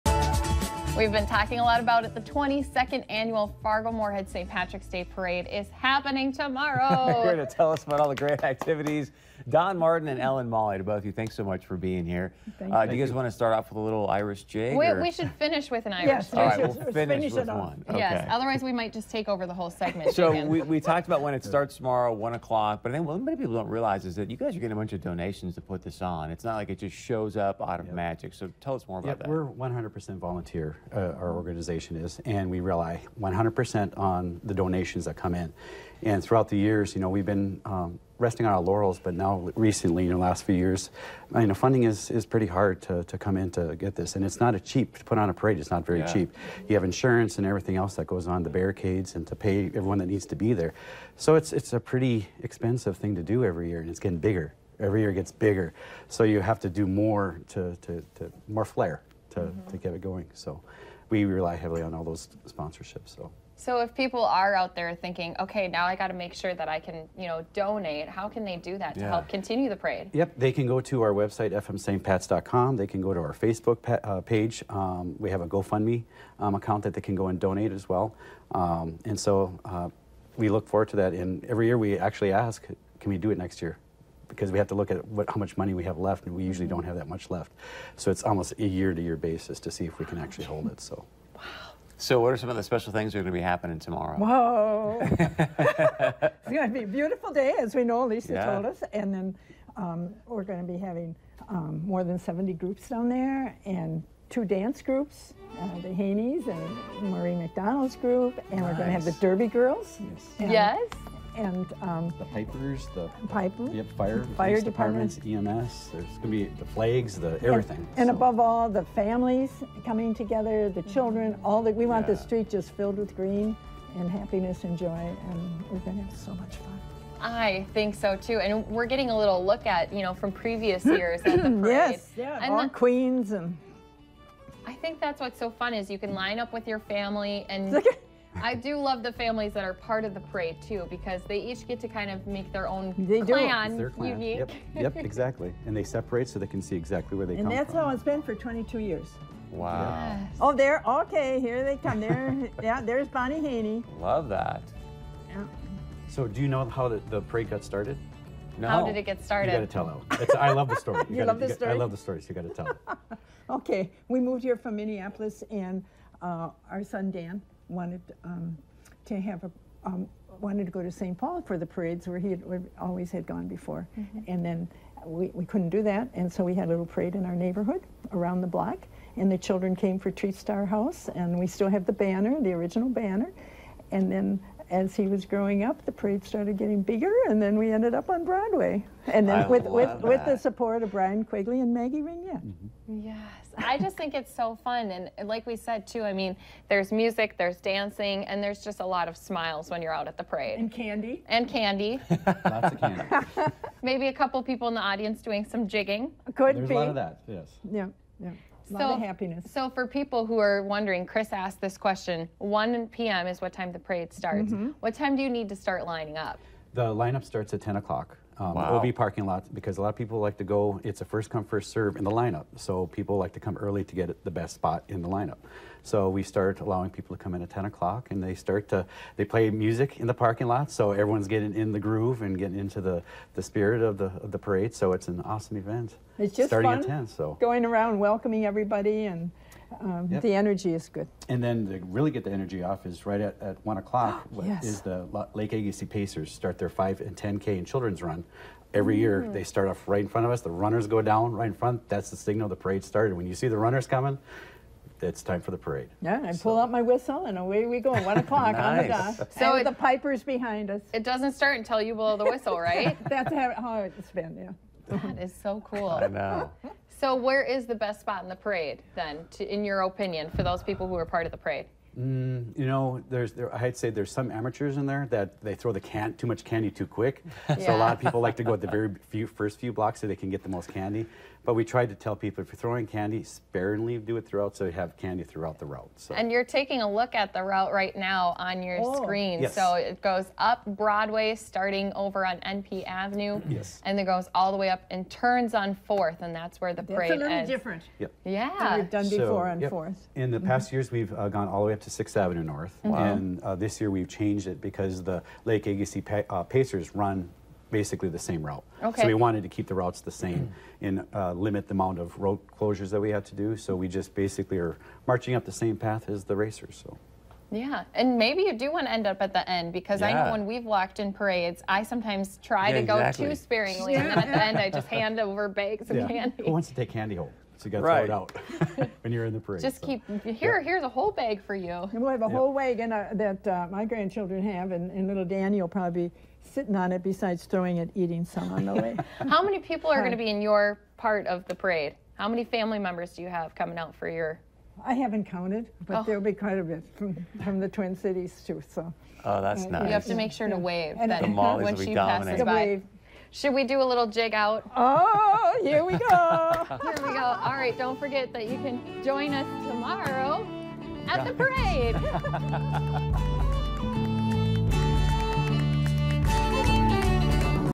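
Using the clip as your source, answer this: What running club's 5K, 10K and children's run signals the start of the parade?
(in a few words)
Lake Agassiz Pacers.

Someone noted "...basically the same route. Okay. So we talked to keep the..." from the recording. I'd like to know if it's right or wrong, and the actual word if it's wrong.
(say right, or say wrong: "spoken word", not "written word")
wrong: "wanted", not "talked".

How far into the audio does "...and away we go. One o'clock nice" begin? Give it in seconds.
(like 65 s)
257 s.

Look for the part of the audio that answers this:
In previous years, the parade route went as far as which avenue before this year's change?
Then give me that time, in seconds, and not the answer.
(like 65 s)
301 s.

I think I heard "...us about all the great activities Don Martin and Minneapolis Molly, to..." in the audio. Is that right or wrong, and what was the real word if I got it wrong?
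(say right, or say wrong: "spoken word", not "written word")
wrong: "Ellen", not "Minneapolis".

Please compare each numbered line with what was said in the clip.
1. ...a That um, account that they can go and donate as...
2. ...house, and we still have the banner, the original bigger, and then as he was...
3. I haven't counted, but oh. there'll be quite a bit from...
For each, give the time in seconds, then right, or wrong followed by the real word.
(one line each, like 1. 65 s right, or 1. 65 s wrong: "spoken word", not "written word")
1. 75 s wrong: "GoFundMe", not "That"
2. 180 s wrong: "banner", not "bigger"
3. 344 s right.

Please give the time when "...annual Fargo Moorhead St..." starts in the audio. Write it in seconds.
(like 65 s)
3 s.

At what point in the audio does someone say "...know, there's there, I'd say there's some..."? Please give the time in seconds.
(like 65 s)
272 s.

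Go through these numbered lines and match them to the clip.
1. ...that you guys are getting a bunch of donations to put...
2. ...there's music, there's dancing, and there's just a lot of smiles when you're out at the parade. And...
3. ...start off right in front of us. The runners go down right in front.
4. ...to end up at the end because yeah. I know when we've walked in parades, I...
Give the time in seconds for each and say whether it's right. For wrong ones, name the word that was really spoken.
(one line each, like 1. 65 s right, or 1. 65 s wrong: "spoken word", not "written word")
1. 24 s right
2. 196 s right
3. 249 s right
4. 318 s right.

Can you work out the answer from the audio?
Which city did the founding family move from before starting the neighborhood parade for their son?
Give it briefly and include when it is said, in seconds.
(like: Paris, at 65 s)
Minneapolis, at 164 s.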